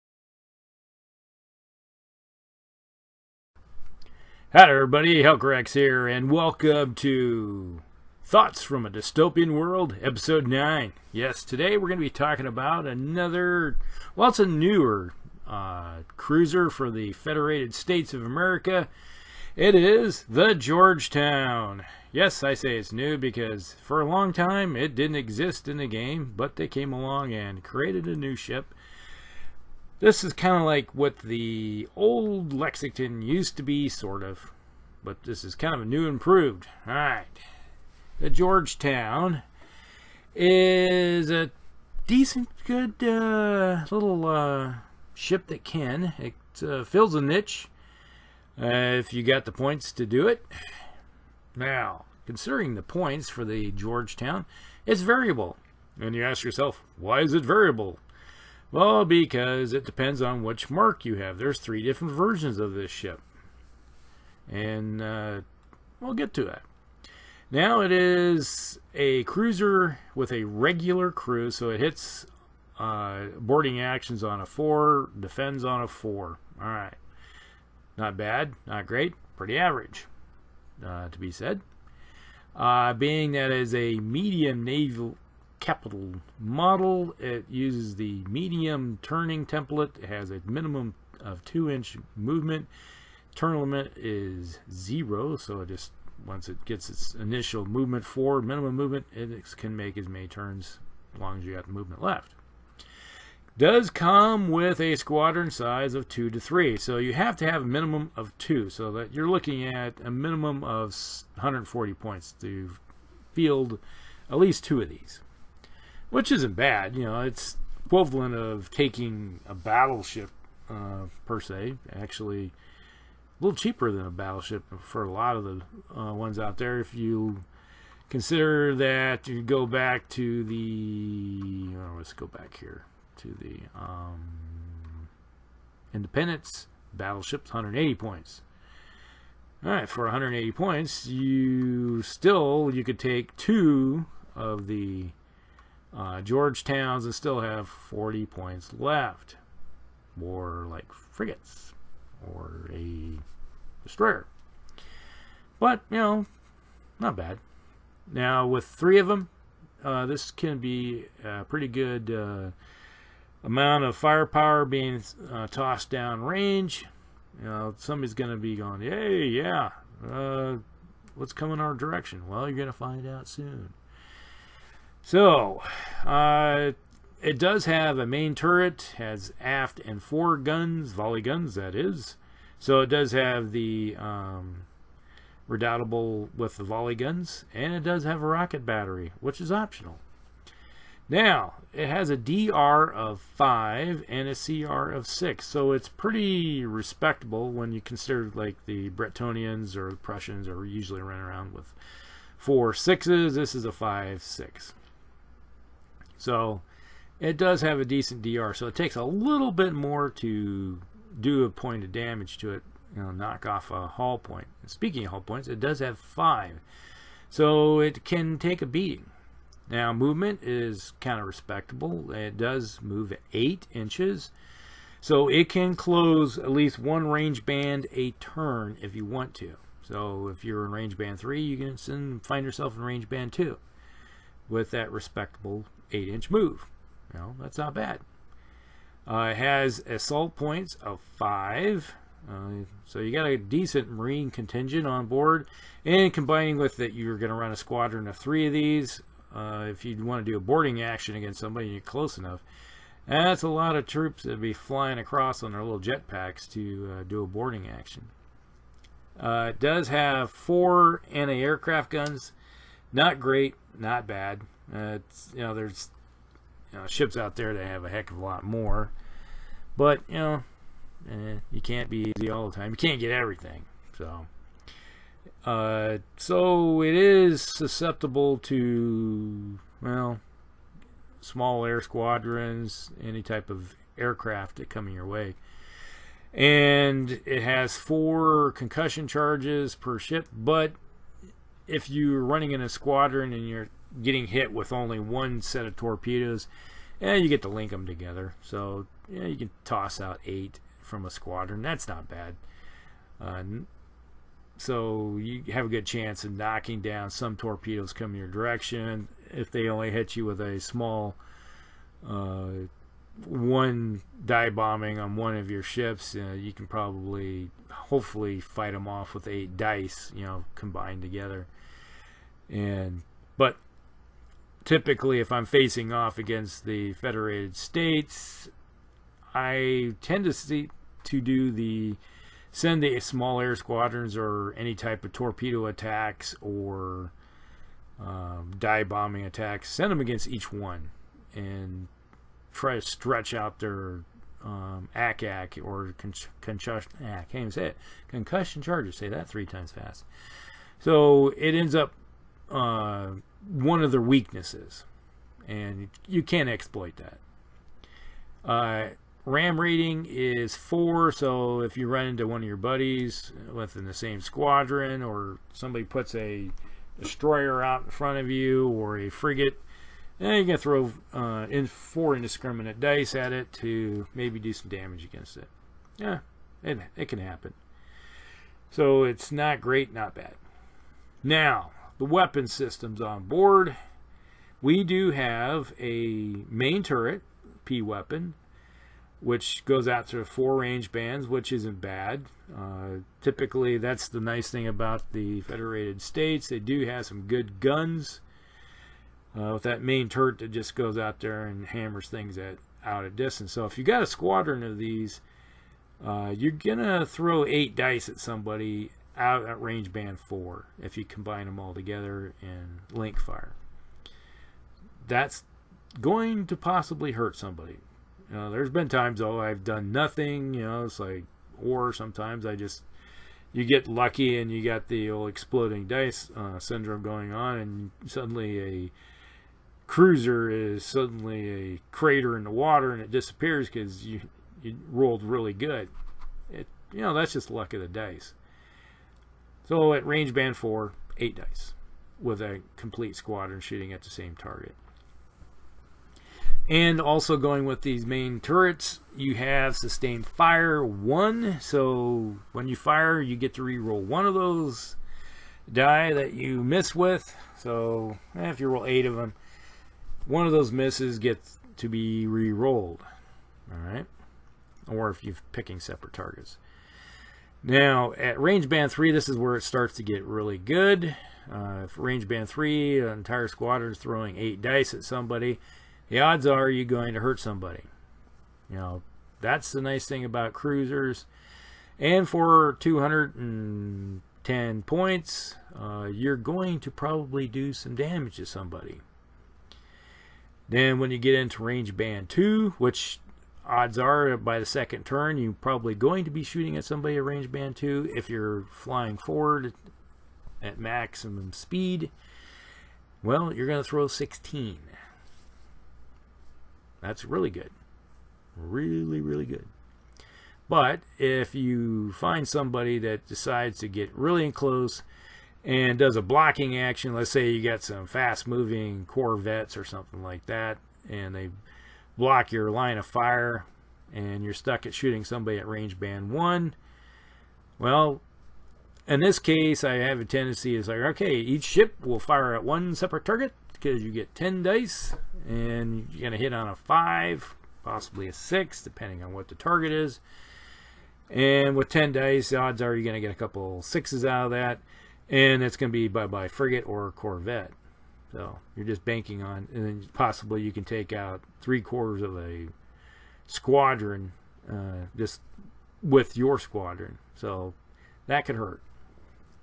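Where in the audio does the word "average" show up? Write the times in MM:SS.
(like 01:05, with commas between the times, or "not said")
01:19.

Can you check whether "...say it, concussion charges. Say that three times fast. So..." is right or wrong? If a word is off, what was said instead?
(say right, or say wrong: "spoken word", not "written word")
right.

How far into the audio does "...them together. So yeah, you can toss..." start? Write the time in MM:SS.
04:57.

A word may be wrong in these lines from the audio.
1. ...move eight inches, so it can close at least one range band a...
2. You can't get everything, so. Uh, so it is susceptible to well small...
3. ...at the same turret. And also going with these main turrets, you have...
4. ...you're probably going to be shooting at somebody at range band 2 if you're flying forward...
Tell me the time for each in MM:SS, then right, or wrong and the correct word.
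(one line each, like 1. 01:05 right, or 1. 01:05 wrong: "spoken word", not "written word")
1. 03:42 right
2. 04:32 right
3. 07:23 wrong: "target", not "turret"
4. 08:15 right.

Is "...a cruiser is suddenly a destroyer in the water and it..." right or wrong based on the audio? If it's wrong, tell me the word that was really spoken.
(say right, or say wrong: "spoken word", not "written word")
wrong: "crater", not "destroyer".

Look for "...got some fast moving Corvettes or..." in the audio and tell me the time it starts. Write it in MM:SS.
08:37.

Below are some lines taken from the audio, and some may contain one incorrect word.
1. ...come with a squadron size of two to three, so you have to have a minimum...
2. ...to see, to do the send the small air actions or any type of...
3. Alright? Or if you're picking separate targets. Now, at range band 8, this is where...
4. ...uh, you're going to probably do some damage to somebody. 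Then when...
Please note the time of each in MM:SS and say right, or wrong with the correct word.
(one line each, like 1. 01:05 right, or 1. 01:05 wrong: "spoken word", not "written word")
1. 01:43 right
2. 05:30 wrong: "squadrons", not "actions"
3. 07:43 wrong: "3", not "8"
4. 08:05 right.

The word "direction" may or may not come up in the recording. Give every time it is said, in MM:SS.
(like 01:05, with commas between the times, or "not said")
02:51, 05:08.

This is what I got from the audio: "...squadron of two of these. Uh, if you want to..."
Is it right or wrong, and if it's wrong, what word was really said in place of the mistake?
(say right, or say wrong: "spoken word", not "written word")
wrong: "three", not "two".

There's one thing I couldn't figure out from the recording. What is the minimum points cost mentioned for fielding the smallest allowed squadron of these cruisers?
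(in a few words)
140 points.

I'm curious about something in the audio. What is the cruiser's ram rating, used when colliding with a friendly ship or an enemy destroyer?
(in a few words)
4.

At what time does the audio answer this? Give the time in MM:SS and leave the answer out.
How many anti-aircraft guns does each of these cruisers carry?
04:20.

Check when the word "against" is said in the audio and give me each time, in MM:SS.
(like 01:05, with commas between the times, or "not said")
04:11, 05:26, 05:40, 06:15.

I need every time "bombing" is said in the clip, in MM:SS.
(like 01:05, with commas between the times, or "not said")
05:14, 05:38.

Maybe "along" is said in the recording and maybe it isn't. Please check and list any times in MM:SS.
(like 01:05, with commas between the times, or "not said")
00:26.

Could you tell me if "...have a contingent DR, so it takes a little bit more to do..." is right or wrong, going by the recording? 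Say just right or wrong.
wrong.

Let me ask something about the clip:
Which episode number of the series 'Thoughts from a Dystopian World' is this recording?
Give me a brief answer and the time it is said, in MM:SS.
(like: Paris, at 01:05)
9, at 00:10.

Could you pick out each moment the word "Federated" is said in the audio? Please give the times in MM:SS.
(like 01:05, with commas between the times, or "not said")
00:17, 05:26, 06:35.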